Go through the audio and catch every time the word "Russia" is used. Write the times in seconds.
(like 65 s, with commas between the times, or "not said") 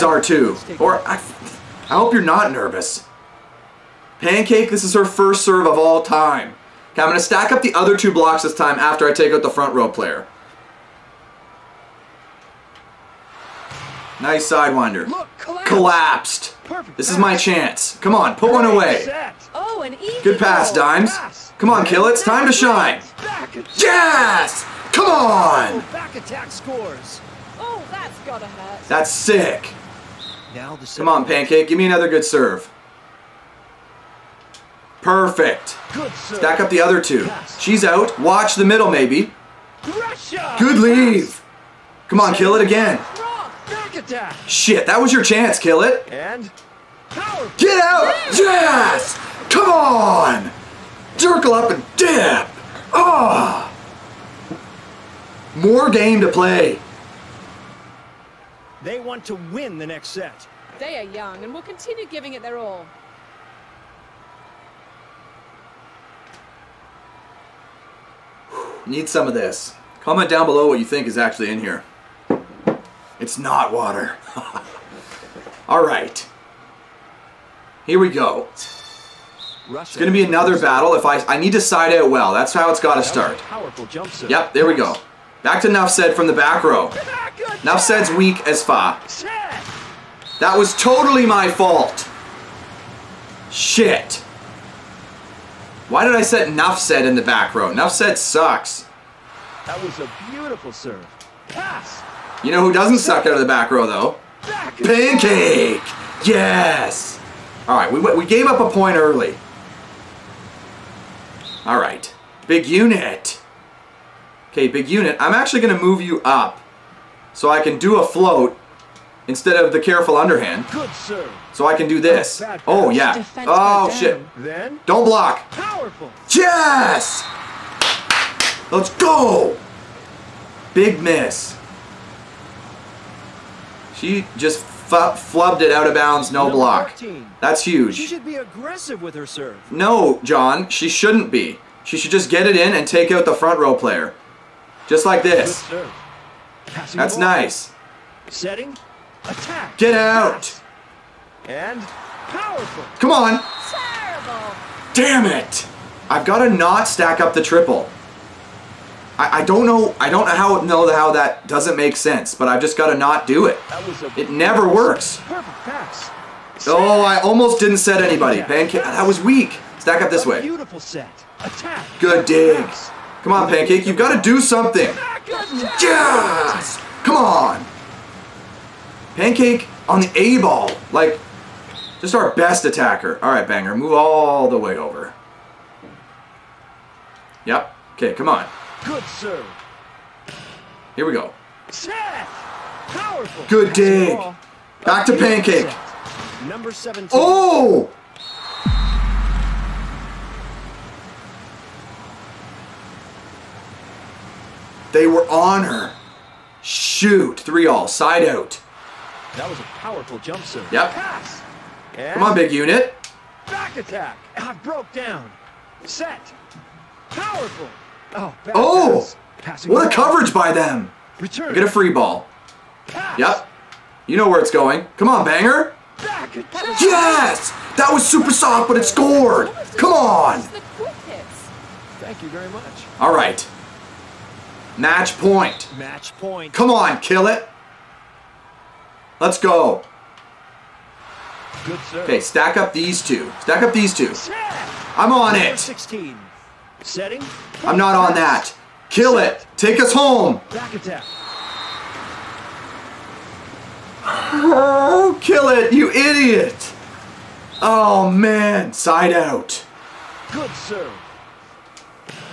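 39 s, 79 s.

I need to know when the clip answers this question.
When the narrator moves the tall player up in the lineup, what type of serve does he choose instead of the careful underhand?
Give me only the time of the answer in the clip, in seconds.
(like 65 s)
118 s.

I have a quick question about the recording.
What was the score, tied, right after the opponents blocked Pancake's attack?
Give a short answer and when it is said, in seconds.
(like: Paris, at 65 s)
3 all, at 207 s.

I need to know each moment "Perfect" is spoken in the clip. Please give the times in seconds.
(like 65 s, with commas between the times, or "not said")
16 s, 35 s.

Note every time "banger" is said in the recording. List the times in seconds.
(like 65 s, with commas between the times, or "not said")
183 s, 225 s.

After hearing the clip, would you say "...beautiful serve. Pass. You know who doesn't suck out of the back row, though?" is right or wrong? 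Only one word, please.
right.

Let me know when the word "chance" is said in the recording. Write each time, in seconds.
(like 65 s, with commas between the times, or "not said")
17 s, 45 s.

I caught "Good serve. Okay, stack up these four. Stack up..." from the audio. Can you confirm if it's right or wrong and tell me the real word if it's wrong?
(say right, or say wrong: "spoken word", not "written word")
wrong: "two", not "four".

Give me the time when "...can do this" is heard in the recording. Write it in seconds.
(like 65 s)
121 s.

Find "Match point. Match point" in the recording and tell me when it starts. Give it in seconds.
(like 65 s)
234 s.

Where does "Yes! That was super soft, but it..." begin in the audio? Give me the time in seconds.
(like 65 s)
225 s.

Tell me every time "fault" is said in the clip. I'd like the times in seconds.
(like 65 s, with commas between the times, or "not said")
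91 s.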